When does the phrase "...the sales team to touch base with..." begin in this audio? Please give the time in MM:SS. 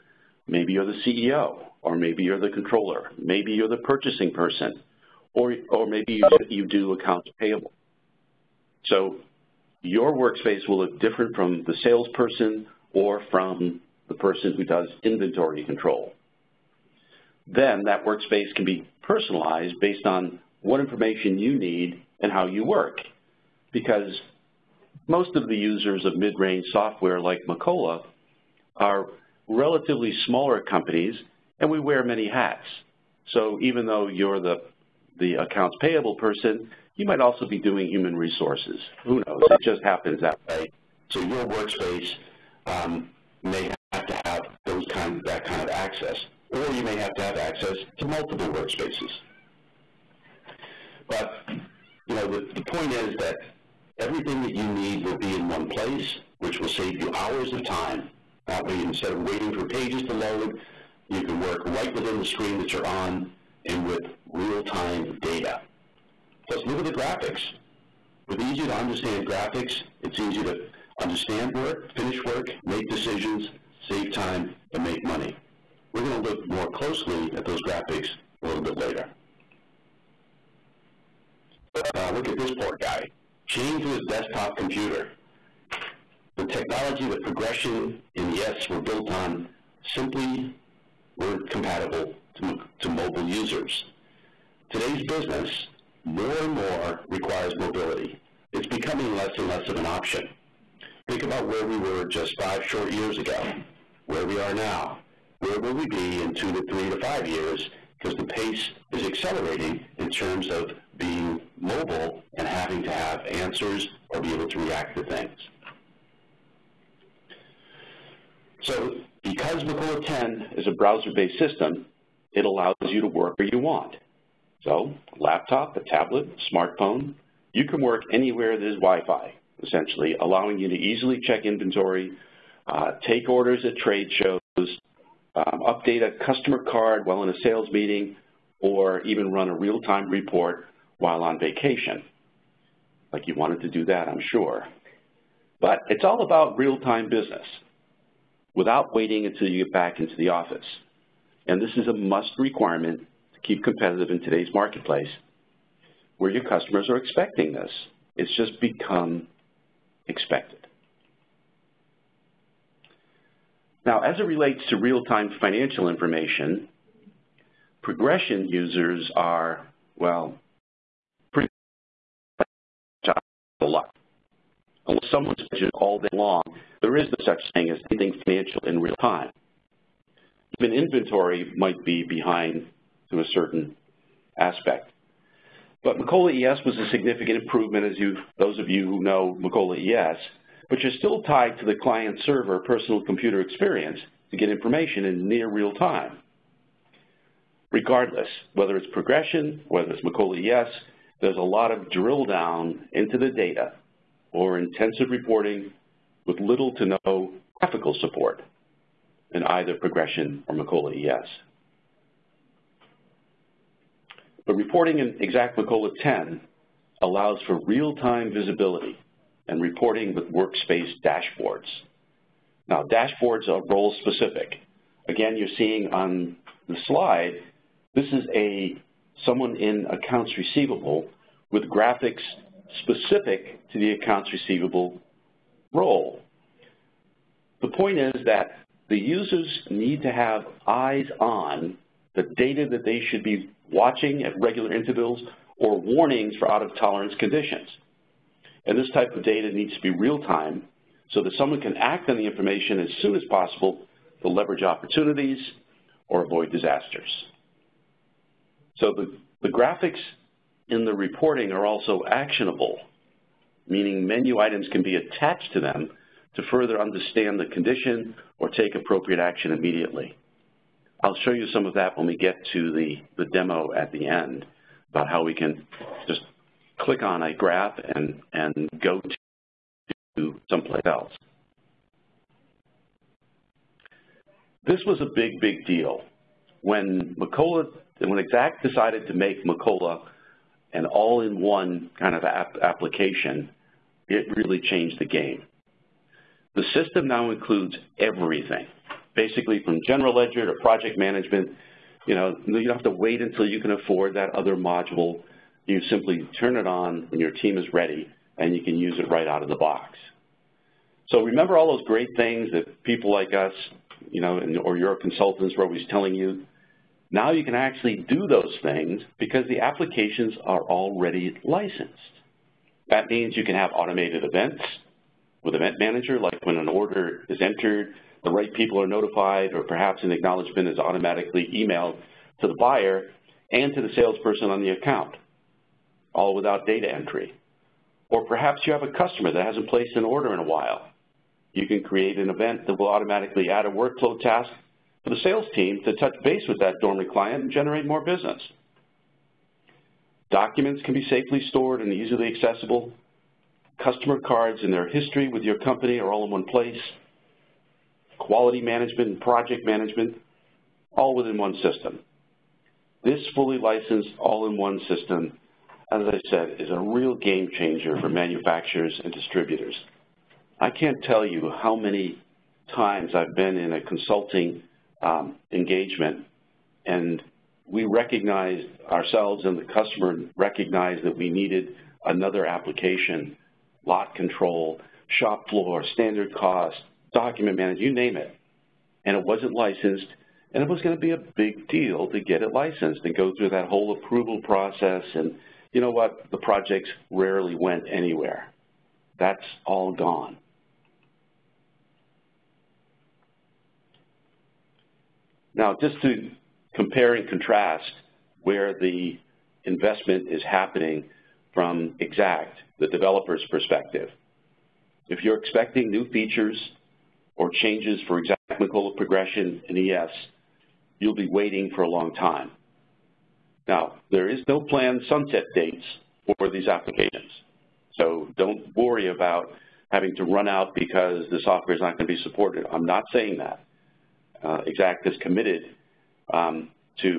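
05:45.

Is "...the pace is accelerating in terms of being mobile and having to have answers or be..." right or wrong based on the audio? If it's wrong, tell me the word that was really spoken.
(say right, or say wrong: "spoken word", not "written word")
right.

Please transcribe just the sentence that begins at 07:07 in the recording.
So don't worry about having to run out because the software is not going to be supported.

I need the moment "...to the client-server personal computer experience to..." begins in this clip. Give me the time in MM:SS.
03:11.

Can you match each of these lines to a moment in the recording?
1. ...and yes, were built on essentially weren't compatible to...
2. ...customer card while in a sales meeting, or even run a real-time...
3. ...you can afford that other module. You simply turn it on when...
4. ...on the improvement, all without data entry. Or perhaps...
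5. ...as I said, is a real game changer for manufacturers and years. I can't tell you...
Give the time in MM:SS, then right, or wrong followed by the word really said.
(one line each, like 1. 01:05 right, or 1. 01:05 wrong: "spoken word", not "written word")
1. 01:28 wrong: "simply", not "essentially"
2. 02:16 right
3. 05:03 right
4. 05:34 wrong: "account", not "improvement"
5. 06:05 wrong: "distributors", not "years".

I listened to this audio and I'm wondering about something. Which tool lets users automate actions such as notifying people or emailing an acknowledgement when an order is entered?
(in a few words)
Event Manager.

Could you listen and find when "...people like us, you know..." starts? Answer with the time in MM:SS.
05:12.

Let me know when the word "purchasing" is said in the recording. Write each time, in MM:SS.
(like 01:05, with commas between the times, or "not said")
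00:03.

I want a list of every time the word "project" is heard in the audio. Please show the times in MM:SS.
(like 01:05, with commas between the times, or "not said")
05:00, 05:59, 06:36.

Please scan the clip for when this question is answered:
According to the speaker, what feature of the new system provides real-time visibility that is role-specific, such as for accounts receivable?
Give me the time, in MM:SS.
03:40.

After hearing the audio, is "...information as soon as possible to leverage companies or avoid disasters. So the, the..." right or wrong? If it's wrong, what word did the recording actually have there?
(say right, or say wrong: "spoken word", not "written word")
wrong: "opportunities", not "companies".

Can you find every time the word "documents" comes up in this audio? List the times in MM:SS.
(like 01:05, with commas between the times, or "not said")
05:50, 06:27.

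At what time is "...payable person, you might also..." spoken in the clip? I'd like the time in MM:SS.
00:35.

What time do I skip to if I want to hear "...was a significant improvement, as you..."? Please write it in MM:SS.
03:06.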